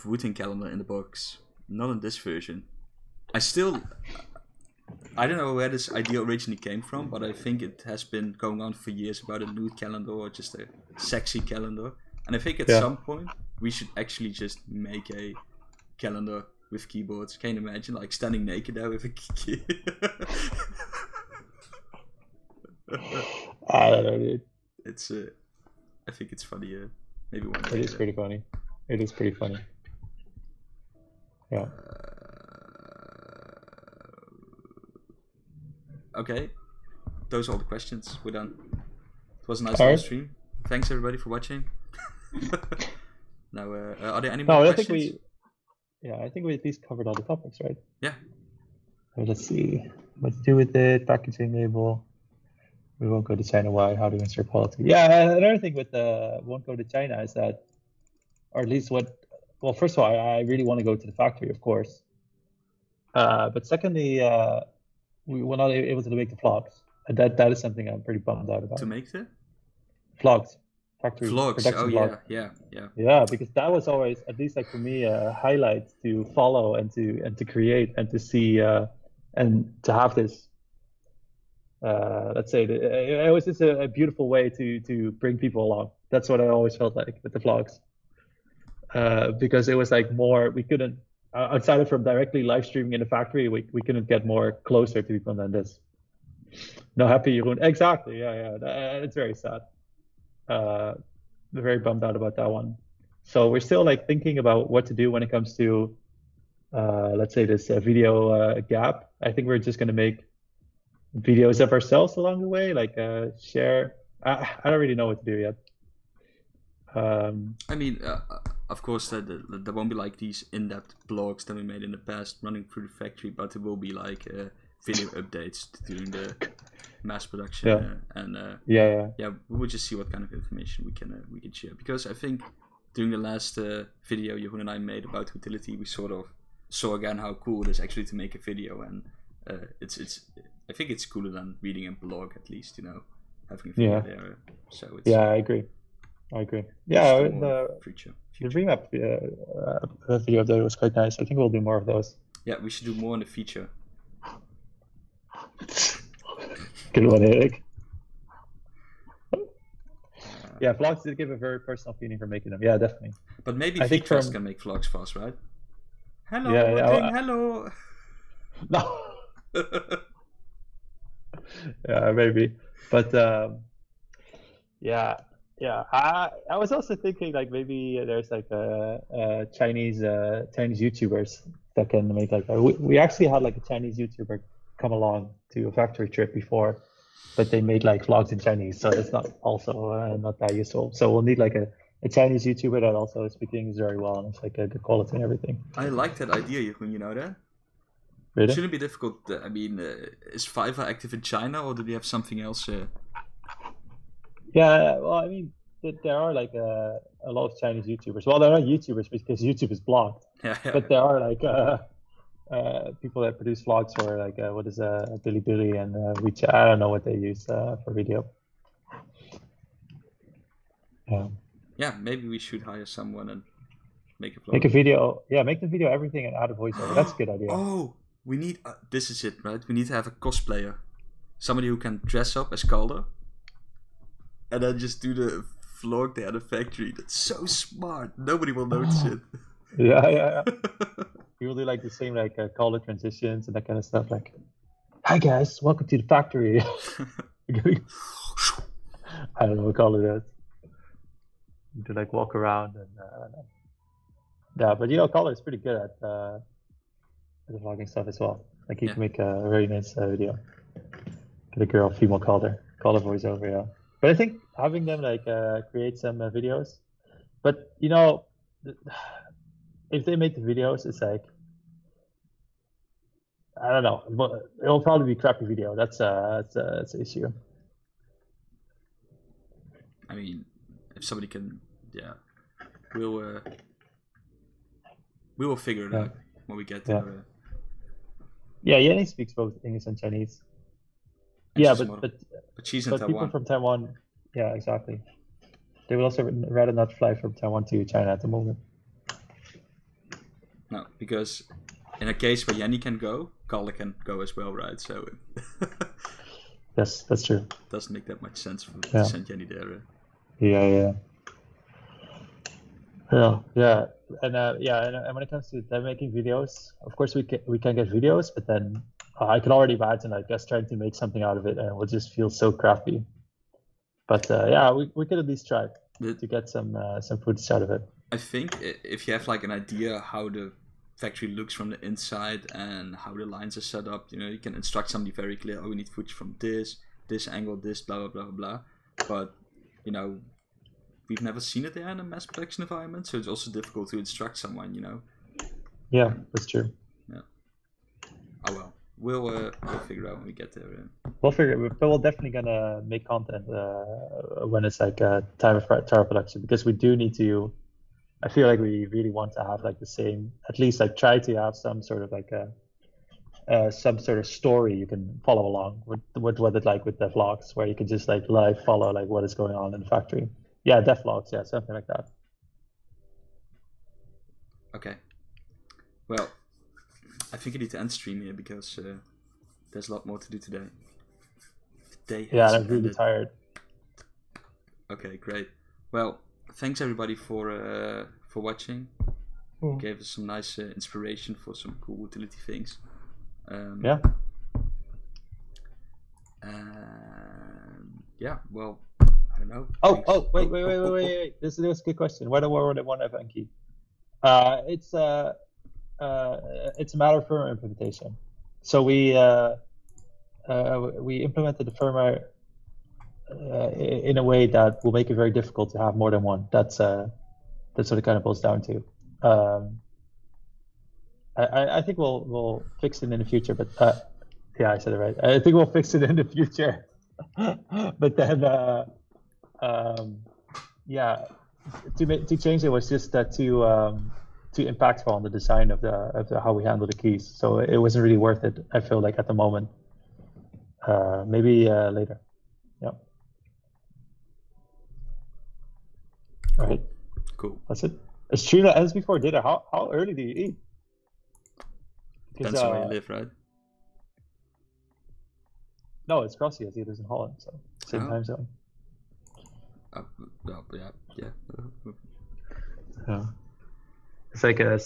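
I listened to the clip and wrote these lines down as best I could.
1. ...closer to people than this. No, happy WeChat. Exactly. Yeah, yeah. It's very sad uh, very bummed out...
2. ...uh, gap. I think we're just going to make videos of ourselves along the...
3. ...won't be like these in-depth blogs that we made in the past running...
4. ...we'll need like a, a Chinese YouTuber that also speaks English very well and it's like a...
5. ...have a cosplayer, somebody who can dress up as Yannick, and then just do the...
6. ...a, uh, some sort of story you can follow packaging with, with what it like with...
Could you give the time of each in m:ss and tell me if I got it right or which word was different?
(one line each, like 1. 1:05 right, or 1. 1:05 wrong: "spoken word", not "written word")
1. 1:34 wrong: "Jeroen", not "WeChat"
2. 1:48 right
3. 1:59 right
4. 3:11 right
5. 3:49 wrong: "Calder", not "Yannick"
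6. 6:02 wrong: "along", not "packaging".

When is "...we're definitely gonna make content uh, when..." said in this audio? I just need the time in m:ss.
5:51.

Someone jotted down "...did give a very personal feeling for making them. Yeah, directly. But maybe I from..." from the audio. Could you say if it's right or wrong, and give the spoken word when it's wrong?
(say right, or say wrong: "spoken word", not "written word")
wrong: "definitely", not "directly".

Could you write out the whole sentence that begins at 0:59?
Well, first of all, I, really want to go to the factory, of course.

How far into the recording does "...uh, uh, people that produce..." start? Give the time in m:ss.
3:31.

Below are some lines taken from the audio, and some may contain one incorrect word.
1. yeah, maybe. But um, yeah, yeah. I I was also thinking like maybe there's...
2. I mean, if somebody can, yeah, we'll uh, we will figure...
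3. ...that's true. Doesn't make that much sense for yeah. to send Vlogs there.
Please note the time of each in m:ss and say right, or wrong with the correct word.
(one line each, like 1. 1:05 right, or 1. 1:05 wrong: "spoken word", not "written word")
1. 2:51 right
2. 4:40 right
3. 5:07 wrong: "Yanni", not "Vlogs".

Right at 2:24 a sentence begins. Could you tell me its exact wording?
there so it's, yeah i agree I agree.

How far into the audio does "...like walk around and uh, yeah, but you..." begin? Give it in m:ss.
4:11.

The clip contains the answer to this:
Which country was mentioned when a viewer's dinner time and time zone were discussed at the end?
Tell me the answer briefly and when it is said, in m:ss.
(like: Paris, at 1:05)
Holland, at 7:37.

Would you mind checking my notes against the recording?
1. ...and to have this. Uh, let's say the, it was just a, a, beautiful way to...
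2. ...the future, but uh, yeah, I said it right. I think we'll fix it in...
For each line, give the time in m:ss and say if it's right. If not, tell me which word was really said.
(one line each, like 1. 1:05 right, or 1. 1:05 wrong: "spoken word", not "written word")
1. 1:19 right
2. 7:03 right.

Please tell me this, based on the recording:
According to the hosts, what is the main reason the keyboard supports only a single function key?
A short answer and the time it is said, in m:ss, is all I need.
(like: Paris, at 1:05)
Firmware implementation, at 6:47.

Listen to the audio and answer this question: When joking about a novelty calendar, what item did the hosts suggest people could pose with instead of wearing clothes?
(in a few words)
Keyboards.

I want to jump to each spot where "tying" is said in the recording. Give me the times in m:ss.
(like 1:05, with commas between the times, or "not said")
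not said.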